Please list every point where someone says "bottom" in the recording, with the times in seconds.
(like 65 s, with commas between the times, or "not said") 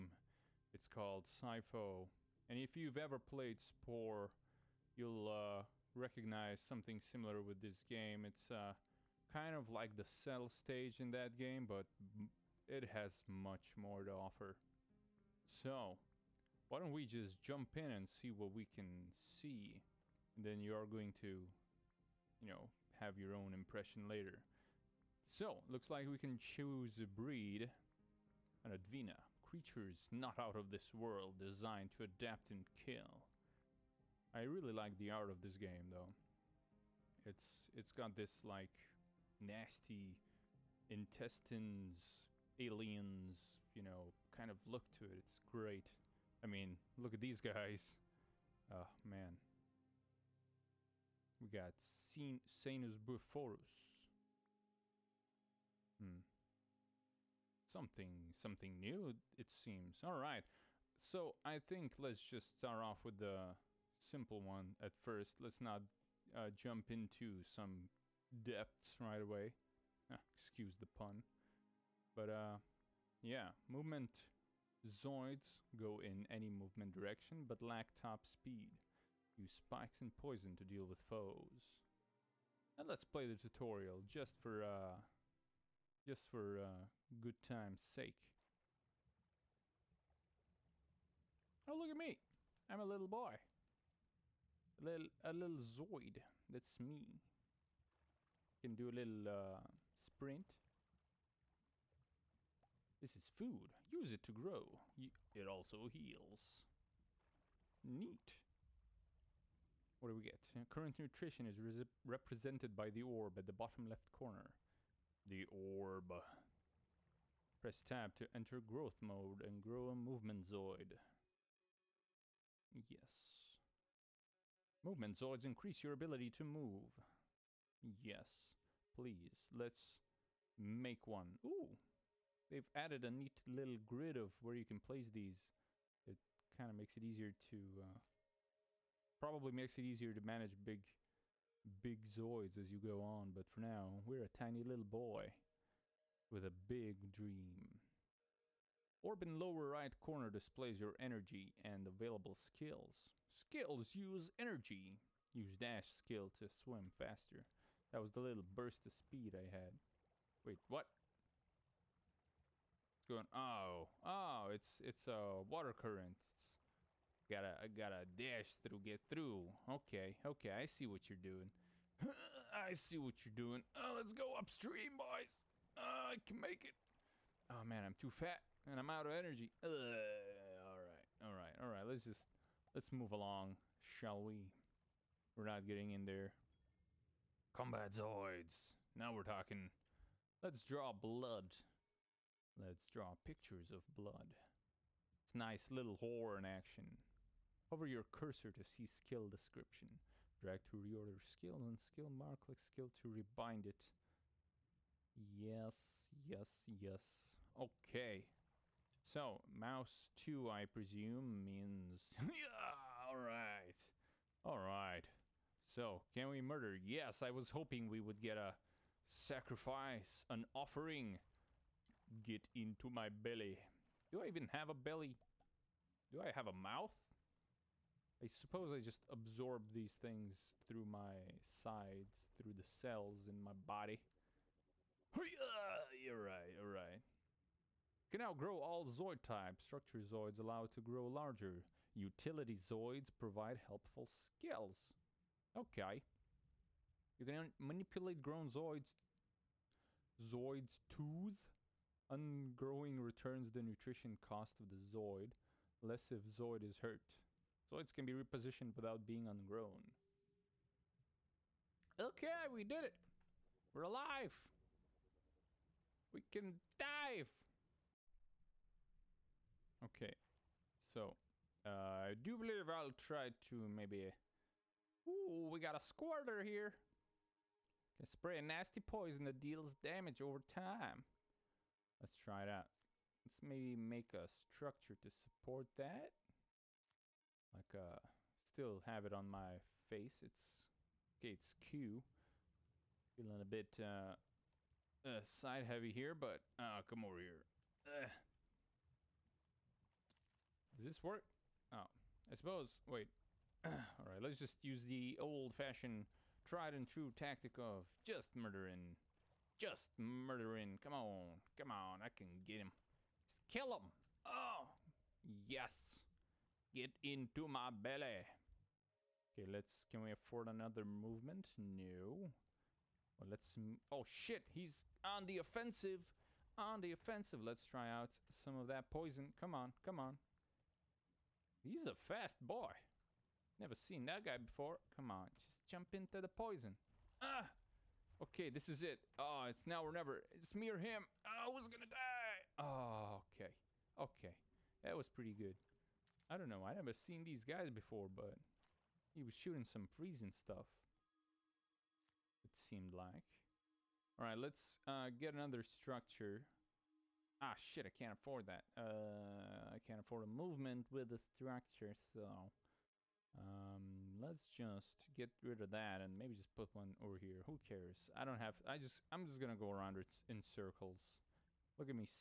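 113 s.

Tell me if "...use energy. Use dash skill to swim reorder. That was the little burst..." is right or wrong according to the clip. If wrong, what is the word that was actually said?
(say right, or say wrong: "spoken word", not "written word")
wrong: "faster", not "reorder".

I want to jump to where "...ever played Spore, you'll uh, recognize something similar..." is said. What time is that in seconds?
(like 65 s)
2 s.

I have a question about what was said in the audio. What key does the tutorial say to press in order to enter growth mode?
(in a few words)
Tab.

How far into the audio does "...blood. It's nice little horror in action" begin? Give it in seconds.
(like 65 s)
193 s.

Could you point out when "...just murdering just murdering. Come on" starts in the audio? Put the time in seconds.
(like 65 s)
308 s.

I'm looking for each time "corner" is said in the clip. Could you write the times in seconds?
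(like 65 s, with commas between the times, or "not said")
114 s, 149 s.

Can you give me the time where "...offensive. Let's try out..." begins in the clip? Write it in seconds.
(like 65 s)
326 s.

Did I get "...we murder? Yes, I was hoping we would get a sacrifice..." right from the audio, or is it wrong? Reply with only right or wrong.
right.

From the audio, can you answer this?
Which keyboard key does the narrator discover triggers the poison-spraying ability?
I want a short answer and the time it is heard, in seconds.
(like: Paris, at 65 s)
Q, at 291 s.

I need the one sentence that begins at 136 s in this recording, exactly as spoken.
It kind of makes it easier to...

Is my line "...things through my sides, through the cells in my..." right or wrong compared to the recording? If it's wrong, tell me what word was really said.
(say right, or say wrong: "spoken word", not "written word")
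right.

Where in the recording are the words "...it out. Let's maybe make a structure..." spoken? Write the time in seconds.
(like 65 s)
282 s.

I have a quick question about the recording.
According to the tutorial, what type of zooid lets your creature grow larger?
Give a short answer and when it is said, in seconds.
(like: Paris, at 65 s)
Structure Zooids, at 239 s.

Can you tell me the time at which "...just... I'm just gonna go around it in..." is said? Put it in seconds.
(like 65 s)
368 s.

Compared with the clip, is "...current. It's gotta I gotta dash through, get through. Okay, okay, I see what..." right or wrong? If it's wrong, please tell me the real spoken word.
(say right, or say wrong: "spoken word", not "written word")
right.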